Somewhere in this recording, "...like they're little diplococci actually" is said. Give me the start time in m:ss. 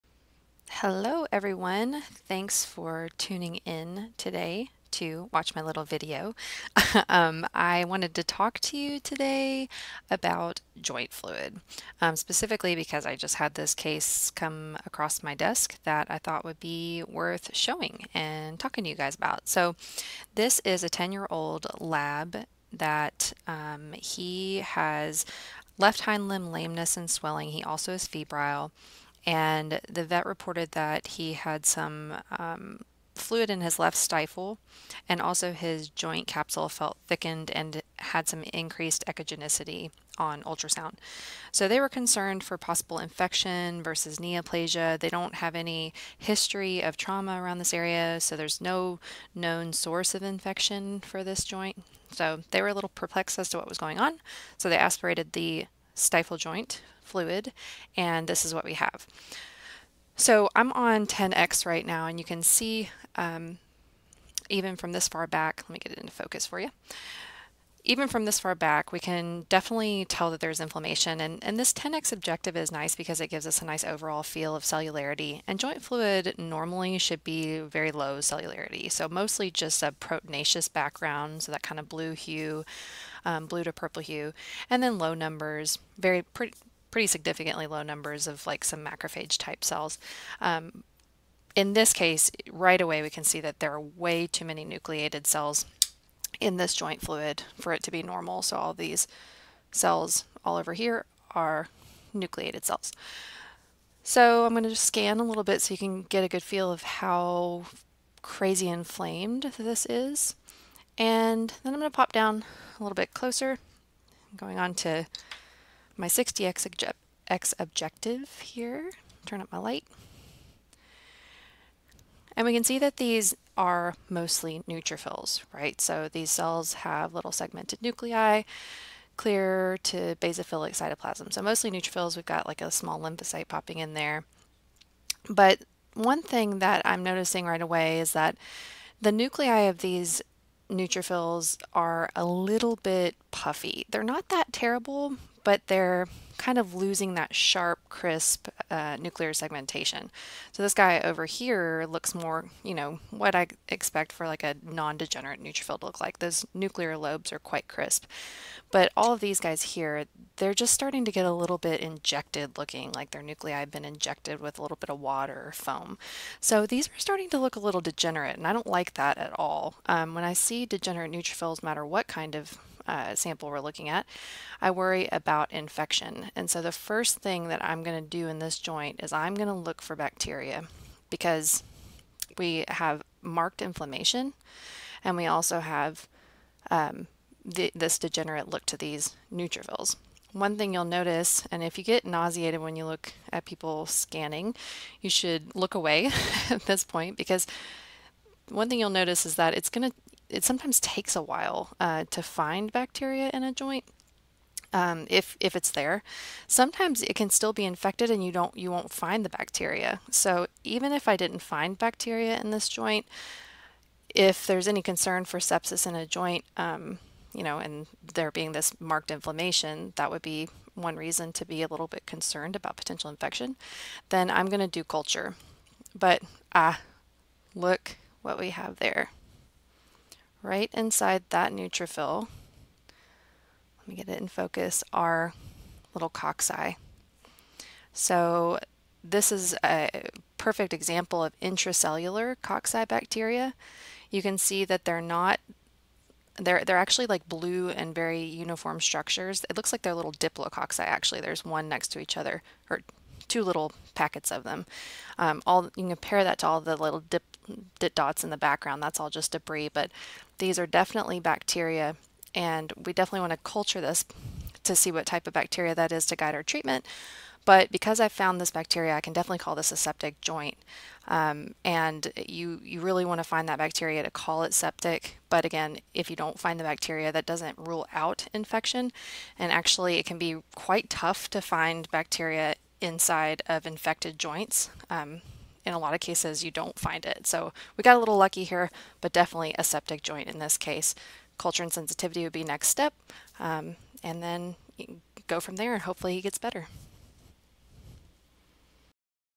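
4:09.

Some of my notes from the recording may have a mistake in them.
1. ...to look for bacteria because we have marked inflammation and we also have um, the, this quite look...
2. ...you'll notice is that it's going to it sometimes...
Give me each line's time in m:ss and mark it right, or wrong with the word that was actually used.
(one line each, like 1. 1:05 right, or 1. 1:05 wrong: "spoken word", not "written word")
1. 2:59 wrong: "degenerate", not "quite"
2. 3:18 right.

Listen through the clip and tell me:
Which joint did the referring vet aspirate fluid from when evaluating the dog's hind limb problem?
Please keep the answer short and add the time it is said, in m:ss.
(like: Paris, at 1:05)
Left stifle, at 0:33.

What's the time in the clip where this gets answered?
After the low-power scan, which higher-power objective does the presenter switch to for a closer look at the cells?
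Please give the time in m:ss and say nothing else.
1:56.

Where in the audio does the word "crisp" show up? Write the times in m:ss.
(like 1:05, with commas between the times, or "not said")
2:27, 2:37.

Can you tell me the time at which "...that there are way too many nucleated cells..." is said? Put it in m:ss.
1:33.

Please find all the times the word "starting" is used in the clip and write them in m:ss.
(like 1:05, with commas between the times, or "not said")
2:40, 2:46.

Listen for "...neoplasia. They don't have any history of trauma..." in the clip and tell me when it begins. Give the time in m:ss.
0:44.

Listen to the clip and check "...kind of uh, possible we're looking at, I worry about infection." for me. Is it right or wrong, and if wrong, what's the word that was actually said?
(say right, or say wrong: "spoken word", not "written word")
wrong: "sample", not "possible".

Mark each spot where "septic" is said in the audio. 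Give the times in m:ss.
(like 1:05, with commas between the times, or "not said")
4:29, 4:34, 4:49.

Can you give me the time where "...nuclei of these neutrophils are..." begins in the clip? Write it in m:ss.
2:19.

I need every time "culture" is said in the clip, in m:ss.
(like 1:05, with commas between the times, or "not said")
3:44, 4:23, 4:51.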